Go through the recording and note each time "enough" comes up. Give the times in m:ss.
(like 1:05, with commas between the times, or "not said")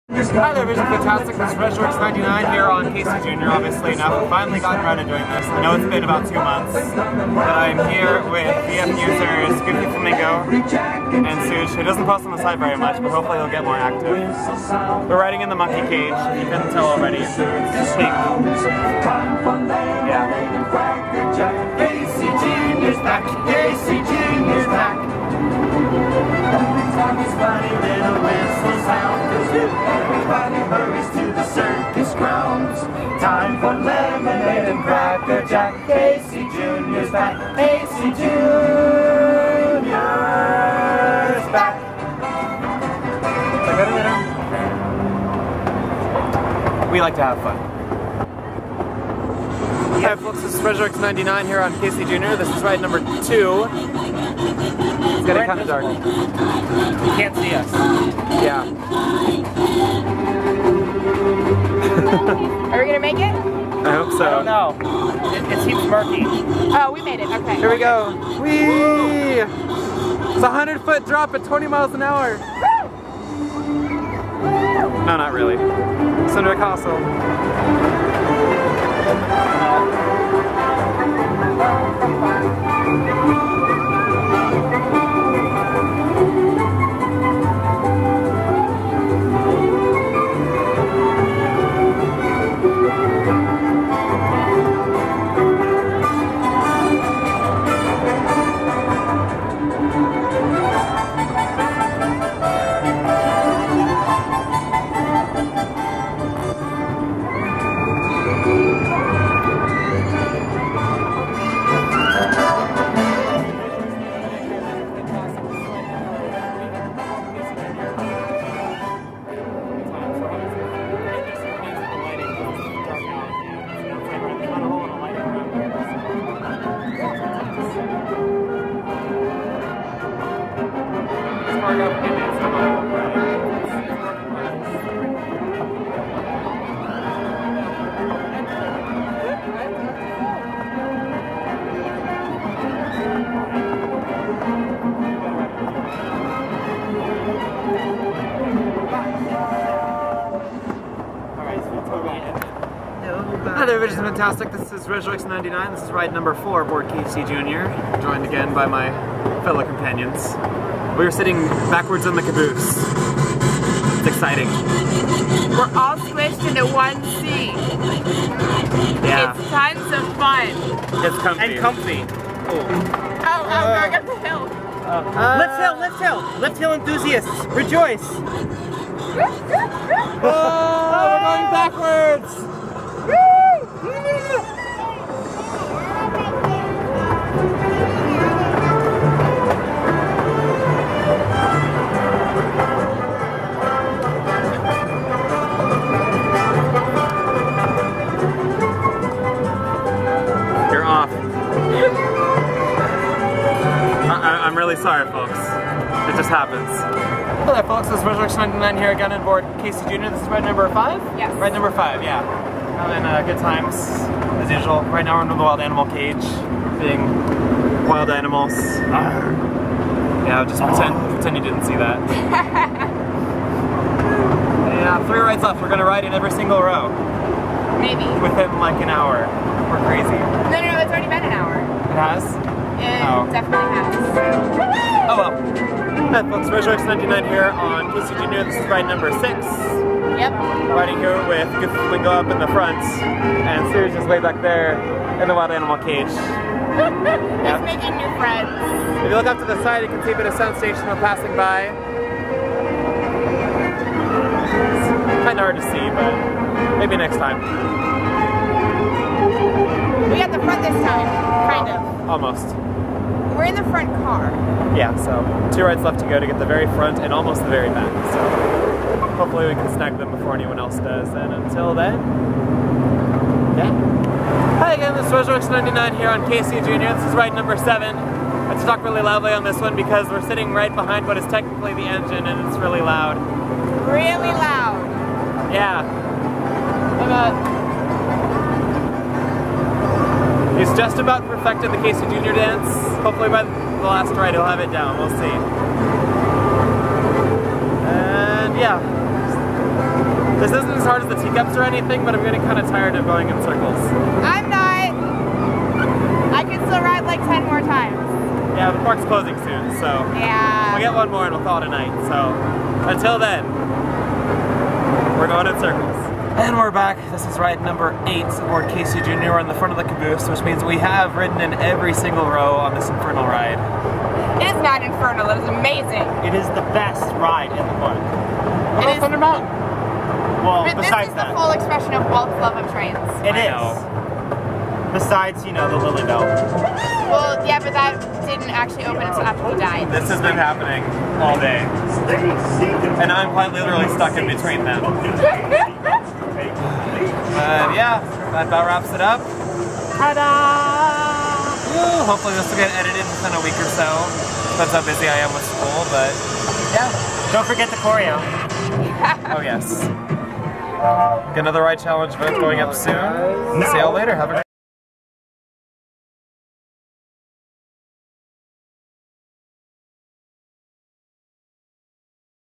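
0:03.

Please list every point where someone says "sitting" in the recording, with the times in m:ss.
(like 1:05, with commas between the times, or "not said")
2:41, 4:40.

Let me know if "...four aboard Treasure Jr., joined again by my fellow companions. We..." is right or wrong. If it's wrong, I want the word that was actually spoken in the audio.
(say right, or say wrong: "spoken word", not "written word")
wrong: "Casey", not "Treasure".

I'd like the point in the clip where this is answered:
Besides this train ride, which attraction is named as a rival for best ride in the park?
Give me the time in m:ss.
5:29.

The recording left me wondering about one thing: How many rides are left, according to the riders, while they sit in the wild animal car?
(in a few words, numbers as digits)
3.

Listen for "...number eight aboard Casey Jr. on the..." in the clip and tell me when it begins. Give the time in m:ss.
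5:17.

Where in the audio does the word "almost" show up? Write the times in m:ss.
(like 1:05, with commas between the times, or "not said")
4:22, 4:27.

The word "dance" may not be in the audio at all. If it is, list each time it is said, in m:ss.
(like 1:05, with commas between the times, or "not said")
4:52.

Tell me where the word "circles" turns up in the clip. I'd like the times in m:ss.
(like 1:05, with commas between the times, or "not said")
5:03, 5:15.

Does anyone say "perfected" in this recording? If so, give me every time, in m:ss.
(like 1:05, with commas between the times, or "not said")
4:51.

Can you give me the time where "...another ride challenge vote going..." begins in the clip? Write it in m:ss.
6:01.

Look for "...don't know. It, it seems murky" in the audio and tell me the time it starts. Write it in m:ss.
1:04.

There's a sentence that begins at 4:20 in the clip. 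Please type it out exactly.
We got the front this time, kind of.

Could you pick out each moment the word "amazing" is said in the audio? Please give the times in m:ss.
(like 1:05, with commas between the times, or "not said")
5:25.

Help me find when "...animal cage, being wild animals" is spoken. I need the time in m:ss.
3:35.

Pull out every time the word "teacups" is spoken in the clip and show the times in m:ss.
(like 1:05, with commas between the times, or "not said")
5:01.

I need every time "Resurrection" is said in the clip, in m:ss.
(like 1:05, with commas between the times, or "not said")
2:34, 3:28.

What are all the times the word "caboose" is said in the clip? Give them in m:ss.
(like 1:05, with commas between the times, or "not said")
2:42, 5:19.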